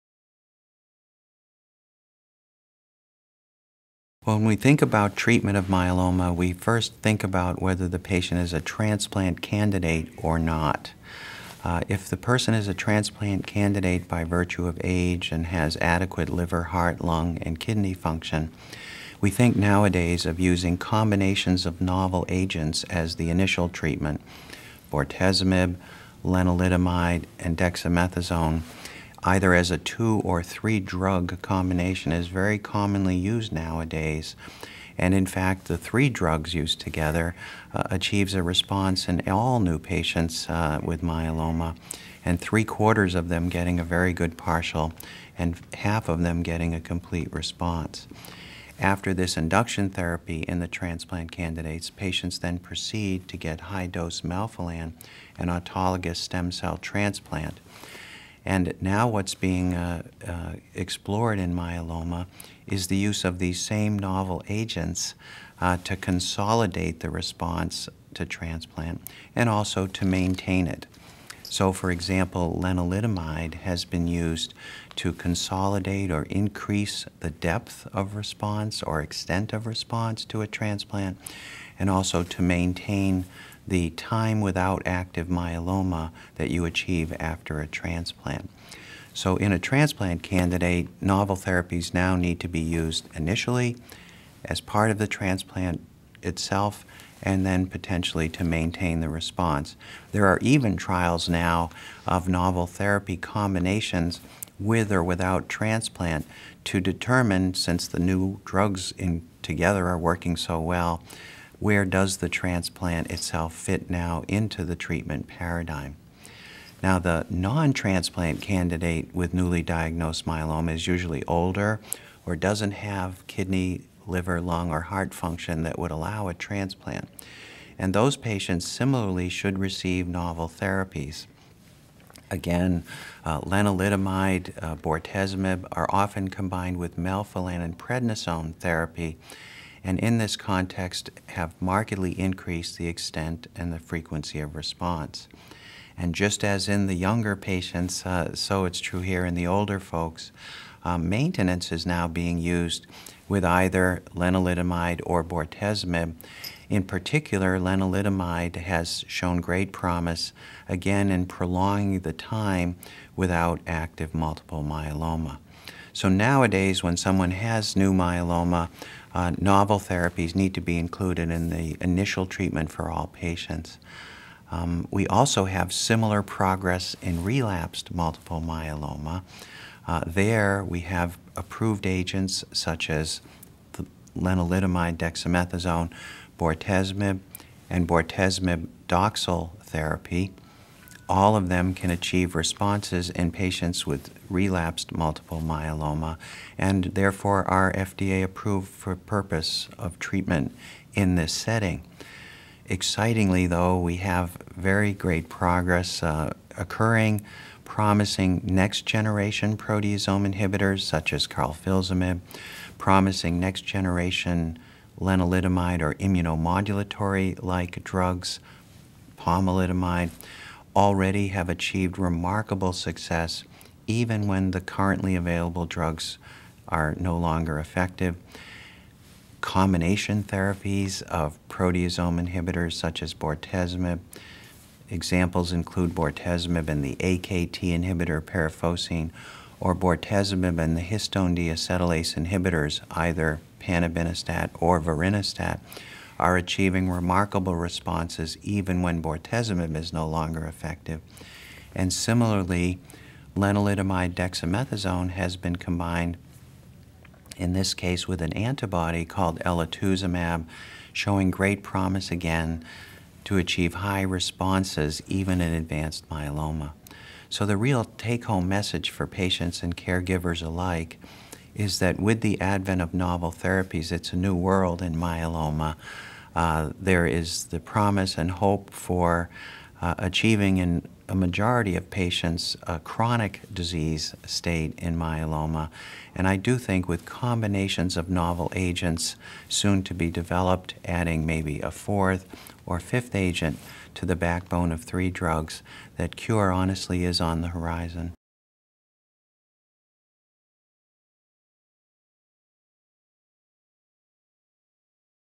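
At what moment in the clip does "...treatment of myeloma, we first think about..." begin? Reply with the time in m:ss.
0:05.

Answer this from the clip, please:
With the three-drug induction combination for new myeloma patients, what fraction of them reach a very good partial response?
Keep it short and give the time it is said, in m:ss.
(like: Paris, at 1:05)
three quarters, at 0:42.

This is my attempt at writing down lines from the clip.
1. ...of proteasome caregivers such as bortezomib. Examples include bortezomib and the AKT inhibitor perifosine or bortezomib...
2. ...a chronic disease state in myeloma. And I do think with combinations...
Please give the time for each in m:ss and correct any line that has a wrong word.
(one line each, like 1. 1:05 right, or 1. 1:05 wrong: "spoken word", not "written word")
1. 3:51 wrong: "inhibitors", not "caregivers"
2. 4:42 right.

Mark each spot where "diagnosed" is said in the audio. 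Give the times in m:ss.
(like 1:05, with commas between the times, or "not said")
1:59.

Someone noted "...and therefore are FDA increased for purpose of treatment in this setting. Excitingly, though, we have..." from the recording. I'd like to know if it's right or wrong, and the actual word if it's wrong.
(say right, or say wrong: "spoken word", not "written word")
wrong: "approved", not "increased".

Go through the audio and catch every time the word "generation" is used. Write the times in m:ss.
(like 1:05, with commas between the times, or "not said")
3:28, 3:33.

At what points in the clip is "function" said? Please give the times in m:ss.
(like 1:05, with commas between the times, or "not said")
0:17, 2:05.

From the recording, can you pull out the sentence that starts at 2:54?
Um, we also have similar progress in relapsed multiple myeloma.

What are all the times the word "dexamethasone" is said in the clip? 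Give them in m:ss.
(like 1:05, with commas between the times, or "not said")
0:27, 3:04, 4:14.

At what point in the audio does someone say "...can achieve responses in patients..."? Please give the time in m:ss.
3:11.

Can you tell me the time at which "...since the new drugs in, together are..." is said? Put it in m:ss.
1:47.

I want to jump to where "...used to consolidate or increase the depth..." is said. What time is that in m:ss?
1:14.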